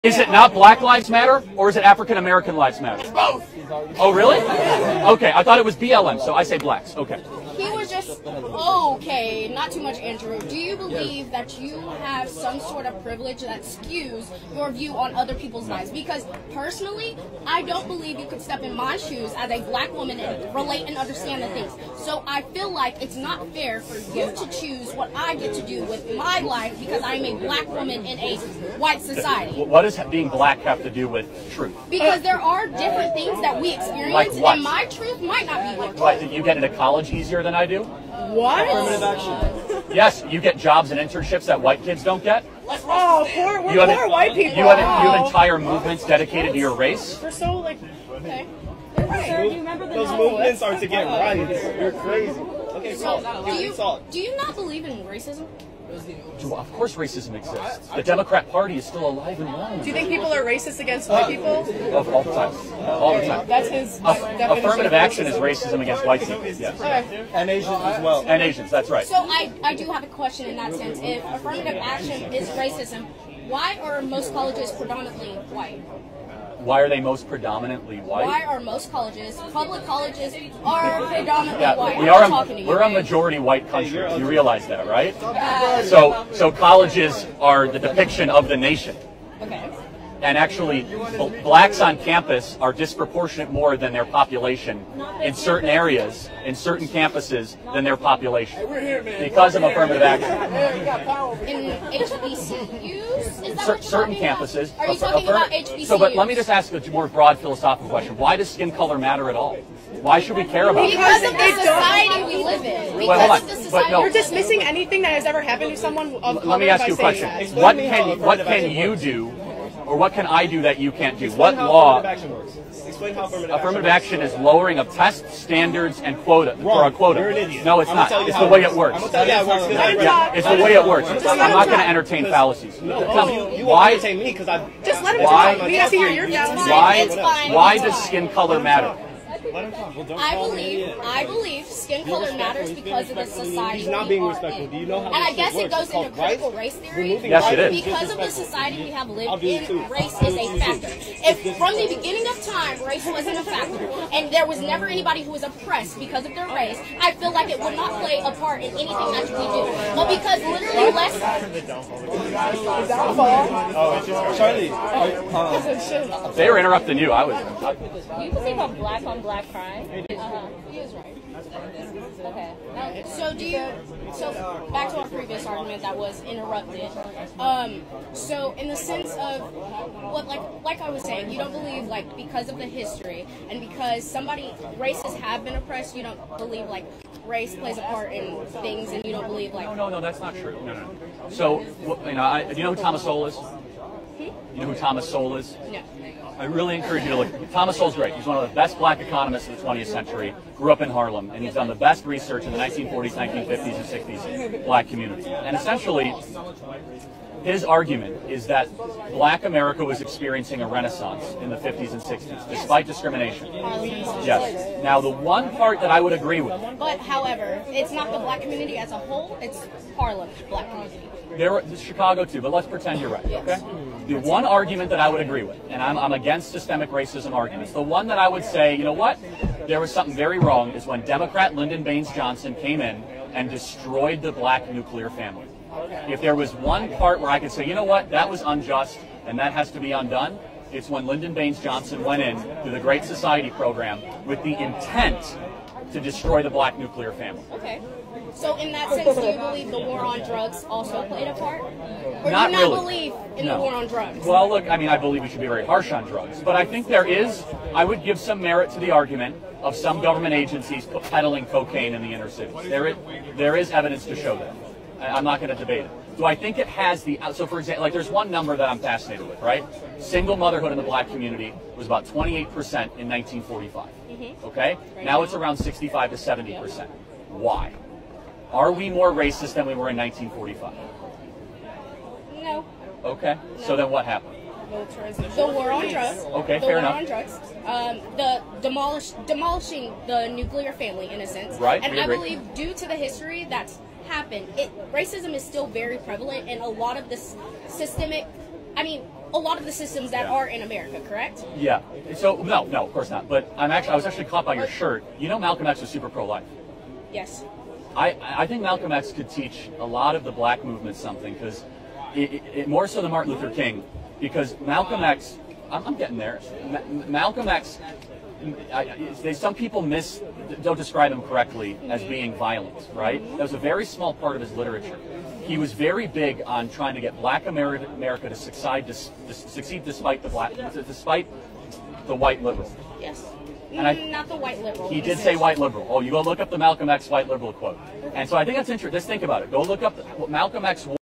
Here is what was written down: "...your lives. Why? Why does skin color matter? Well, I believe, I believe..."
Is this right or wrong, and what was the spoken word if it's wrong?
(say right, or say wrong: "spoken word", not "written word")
wrong: "fallacies", not "lives".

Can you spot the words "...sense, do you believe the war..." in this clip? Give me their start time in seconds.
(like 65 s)
248 s.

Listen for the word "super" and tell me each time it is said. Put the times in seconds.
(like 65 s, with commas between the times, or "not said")
305 s.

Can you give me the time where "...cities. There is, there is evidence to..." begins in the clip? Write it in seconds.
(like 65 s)
262 s.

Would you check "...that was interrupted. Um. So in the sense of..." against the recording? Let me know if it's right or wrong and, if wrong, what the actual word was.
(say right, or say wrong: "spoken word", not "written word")
right.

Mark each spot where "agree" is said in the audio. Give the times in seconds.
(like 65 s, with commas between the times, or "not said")
216 s, 225 s, 292 s.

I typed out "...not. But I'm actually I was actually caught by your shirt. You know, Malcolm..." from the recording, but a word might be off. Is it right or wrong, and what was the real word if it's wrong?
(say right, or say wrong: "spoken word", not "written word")
right.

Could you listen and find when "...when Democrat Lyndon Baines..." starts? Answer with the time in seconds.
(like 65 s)
230 s.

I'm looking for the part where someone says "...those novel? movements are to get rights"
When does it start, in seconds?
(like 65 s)
49 s.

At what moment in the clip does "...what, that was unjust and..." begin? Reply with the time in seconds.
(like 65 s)
237 s.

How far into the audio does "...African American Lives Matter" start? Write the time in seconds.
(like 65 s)
1 s.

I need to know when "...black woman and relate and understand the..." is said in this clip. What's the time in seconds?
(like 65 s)
19 s.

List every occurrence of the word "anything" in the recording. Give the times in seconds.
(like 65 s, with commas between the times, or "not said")
114 s, 158 s.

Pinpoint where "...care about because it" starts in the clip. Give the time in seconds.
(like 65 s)
110 s.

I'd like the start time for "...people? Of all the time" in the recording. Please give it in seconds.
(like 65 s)
61 s.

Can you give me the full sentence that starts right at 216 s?
But, however, it's not the black community as a whole, it's Harlem black community.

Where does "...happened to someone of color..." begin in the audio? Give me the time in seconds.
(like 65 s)
115 s.